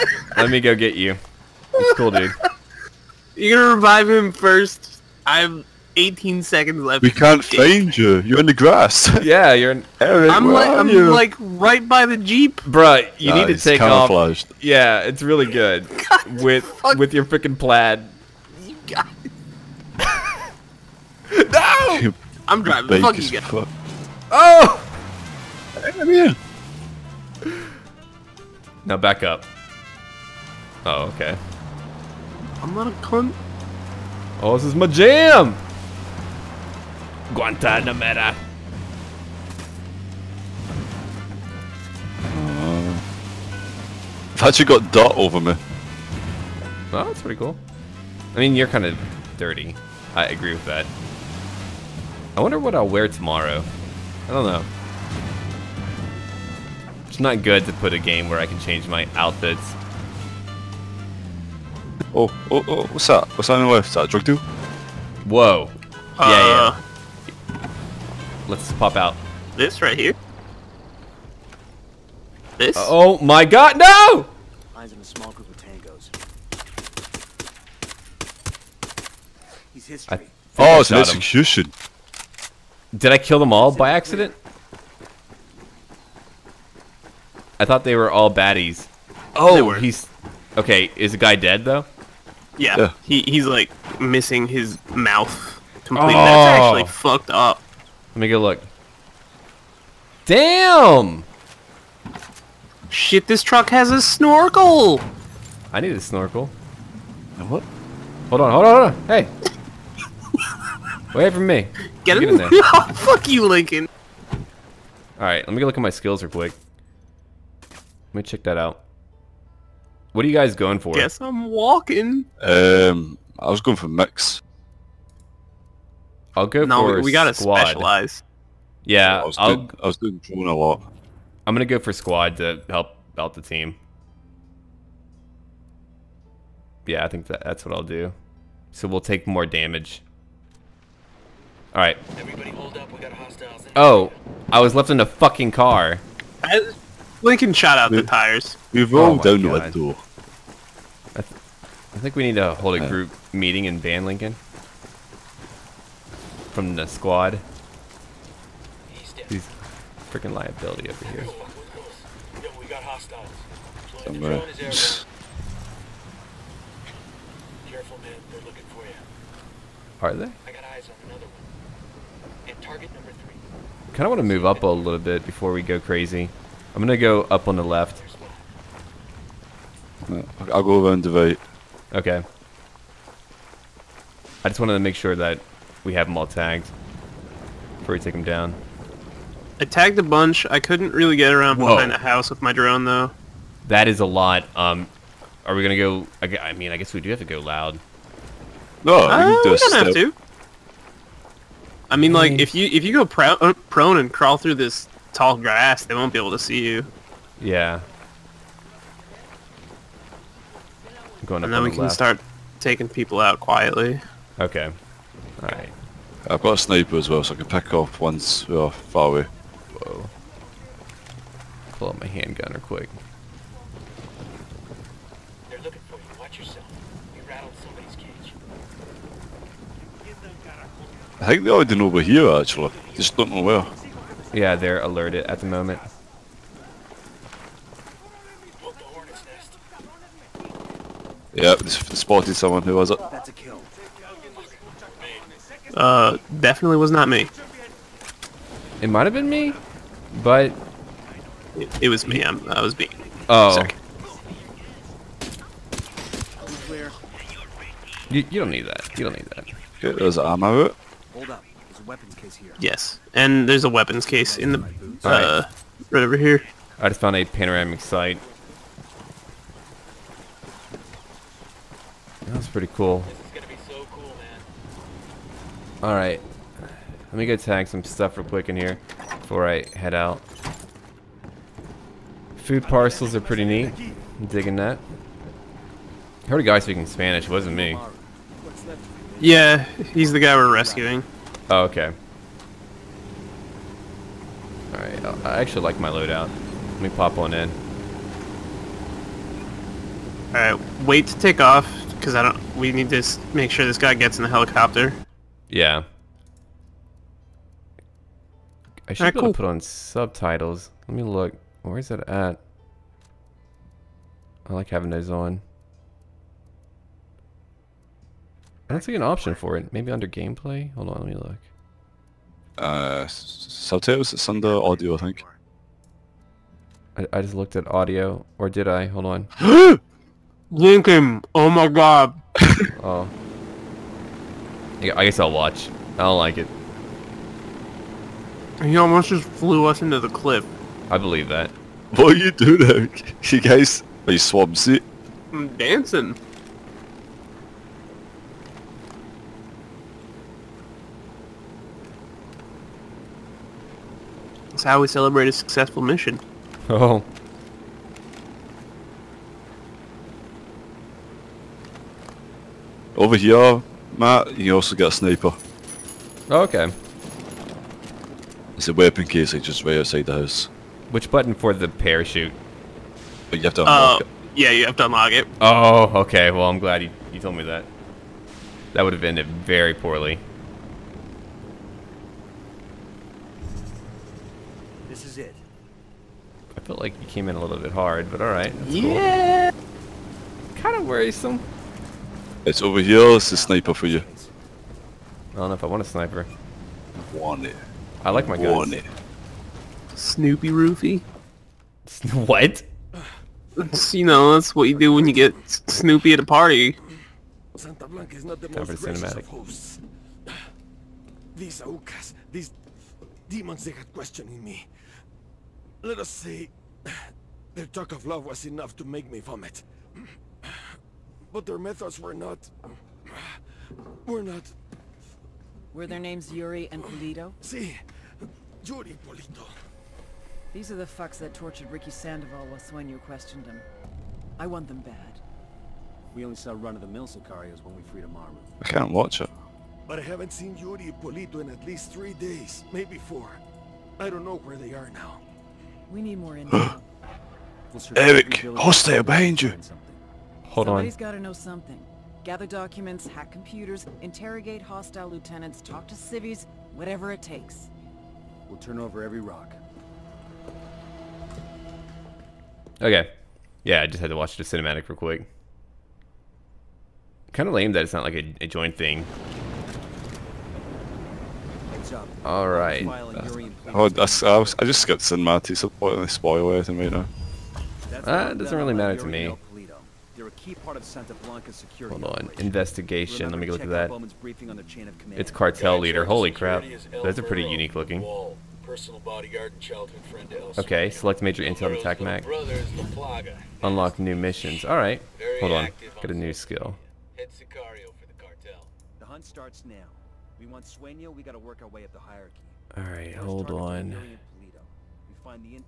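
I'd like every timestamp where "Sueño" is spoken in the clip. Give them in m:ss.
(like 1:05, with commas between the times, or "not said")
7:12, 8:20.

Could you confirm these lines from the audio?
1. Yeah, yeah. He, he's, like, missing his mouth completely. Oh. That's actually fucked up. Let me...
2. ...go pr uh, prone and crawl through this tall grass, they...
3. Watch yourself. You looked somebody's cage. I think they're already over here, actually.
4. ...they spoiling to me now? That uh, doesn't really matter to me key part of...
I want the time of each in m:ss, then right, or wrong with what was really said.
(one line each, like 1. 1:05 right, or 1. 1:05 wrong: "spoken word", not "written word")
1. 1:32 right
2. 3:22 right
3. 3:46 wrong: "rattled", not "looked"
4. 7:55 right.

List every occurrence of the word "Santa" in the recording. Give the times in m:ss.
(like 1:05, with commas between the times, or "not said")
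6:47, 8:00.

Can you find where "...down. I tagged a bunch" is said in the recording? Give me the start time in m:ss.
3:08.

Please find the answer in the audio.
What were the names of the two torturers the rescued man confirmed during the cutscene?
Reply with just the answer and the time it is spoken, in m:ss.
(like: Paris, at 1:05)
Yuri and Polito, at 7:06.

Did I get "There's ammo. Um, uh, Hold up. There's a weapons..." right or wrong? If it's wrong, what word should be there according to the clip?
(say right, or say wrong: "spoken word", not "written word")
right.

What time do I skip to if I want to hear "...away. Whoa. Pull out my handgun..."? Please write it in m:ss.
3:39.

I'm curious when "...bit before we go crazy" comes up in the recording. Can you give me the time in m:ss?
2:54.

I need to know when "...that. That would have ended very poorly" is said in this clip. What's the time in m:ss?
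6:17.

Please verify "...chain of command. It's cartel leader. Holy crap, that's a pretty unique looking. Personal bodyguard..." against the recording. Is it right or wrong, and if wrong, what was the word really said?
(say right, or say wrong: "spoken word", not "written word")
right.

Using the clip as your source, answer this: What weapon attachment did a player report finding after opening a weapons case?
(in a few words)
panoramic sight.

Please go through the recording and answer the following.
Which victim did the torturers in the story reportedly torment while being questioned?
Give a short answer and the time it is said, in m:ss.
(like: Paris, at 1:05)
Ricky Sandoval, at 7:11.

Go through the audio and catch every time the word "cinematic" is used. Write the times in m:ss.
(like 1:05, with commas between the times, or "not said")
7:44, 7:55.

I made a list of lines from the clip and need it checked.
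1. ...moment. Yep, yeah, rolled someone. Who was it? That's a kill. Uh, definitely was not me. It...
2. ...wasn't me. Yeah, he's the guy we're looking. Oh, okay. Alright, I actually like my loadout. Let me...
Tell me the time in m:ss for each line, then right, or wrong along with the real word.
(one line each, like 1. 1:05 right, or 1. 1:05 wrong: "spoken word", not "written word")
1. 3:55 wrong: "spotted", not "rolled"
2. 4:47 wrong: "rescuing", not "looking".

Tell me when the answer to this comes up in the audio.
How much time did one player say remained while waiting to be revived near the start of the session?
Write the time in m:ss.
0:05.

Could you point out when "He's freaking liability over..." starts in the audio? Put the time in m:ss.
2:39.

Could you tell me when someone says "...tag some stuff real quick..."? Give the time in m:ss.
4:37.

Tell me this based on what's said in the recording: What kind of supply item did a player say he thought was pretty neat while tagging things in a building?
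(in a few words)
Food parcels.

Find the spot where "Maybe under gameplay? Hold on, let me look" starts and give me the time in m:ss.
5:19.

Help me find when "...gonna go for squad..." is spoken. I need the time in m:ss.
2:11.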